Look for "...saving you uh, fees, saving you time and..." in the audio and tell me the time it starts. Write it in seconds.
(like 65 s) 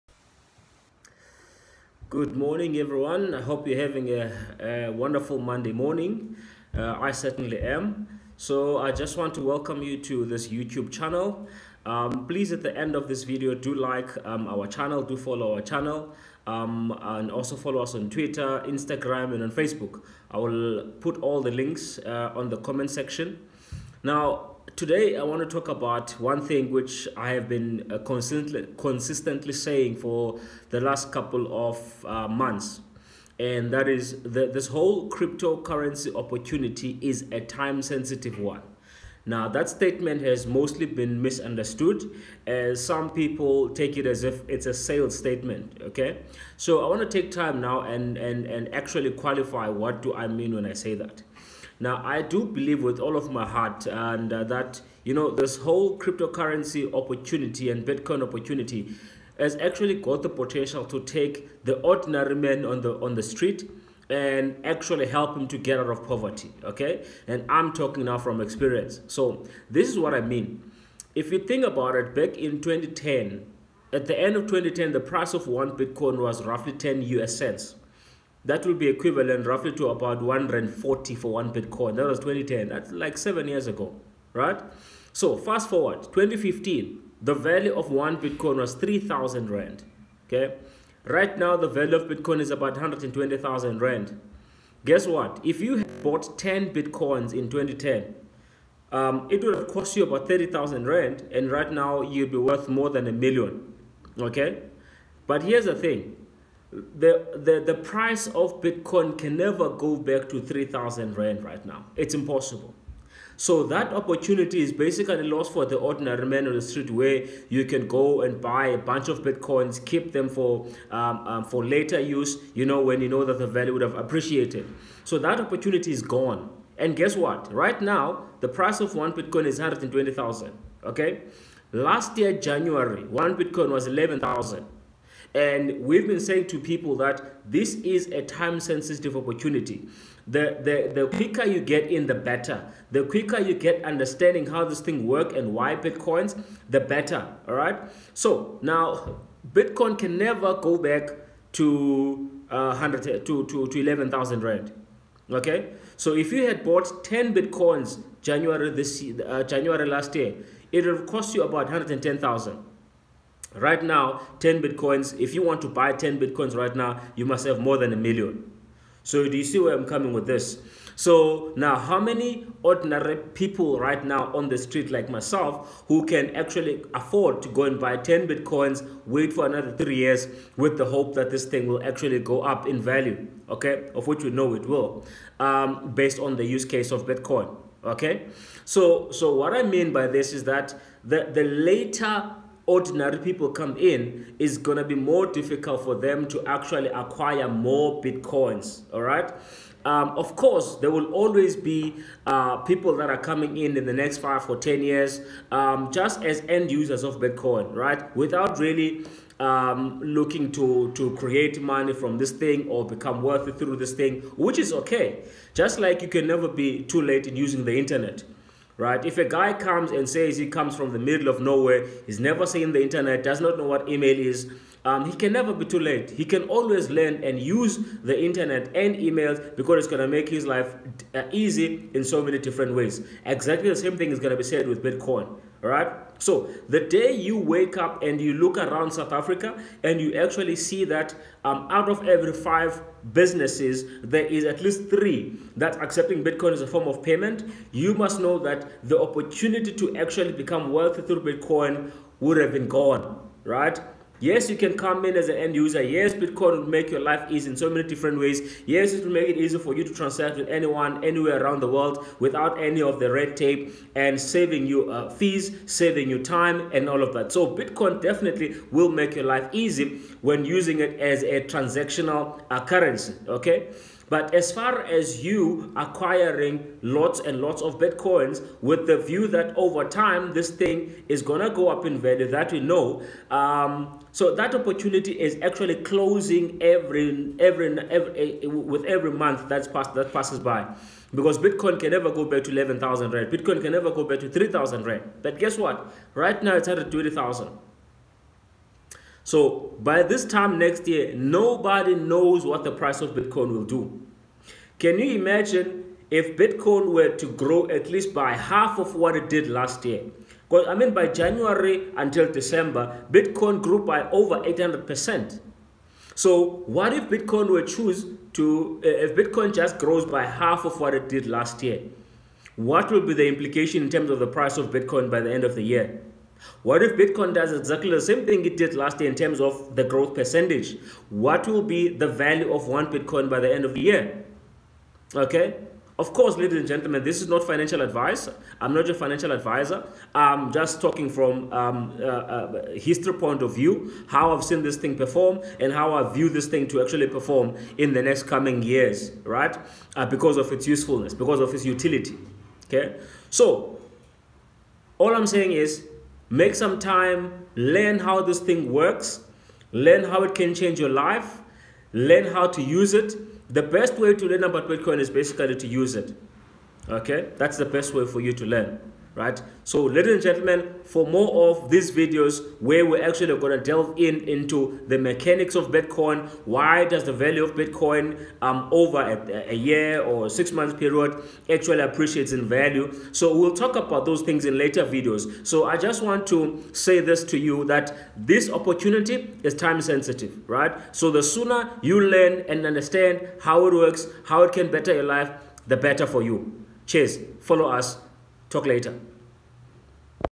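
264 s.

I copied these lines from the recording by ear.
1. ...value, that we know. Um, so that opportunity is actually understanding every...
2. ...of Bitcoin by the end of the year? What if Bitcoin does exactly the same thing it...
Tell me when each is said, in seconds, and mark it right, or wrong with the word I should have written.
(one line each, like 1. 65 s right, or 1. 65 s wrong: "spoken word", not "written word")
1. 281 s wrong: "closing", not "understanding"
2. 324 s right.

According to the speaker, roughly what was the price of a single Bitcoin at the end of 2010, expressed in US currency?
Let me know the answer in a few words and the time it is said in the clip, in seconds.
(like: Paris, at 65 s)
10 US cents, at 76 s.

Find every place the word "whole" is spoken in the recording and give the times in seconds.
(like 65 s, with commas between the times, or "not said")
34 s, 55 s.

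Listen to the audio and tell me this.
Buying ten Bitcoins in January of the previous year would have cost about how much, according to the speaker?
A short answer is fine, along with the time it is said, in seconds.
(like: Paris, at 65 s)
110,000, at 161 s.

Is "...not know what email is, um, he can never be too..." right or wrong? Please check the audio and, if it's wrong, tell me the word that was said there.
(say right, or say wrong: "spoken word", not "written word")
right.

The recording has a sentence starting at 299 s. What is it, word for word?
So by this time next year, nobody knows what the price of Bitcoin will do.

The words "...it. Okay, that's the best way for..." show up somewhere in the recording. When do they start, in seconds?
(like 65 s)
365 s.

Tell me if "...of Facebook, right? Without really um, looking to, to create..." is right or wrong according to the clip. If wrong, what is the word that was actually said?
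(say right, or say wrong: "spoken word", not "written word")
wrong: "Bitcoin", not "Facebook".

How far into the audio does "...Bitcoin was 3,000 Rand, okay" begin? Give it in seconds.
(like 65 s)
88 s.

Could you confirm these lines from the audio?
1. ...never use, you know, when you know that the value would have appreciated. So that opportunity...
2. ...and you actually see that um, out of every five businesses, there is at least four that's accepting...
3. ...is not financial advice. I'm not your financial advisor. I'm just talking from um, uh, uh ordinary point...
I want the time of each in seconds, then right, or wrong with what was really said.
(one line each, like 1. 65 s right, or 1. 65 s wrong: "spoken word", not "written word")
1. 121 s wrong: "later", not "never"
2. 239 s wrong: "three", not "four"
3. 337 s wrong: "history", not "ordinary".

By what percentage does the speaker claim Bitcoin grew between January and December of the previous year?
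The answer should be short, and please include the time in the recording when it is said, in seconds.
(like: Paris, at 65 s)
800%, at 314 s.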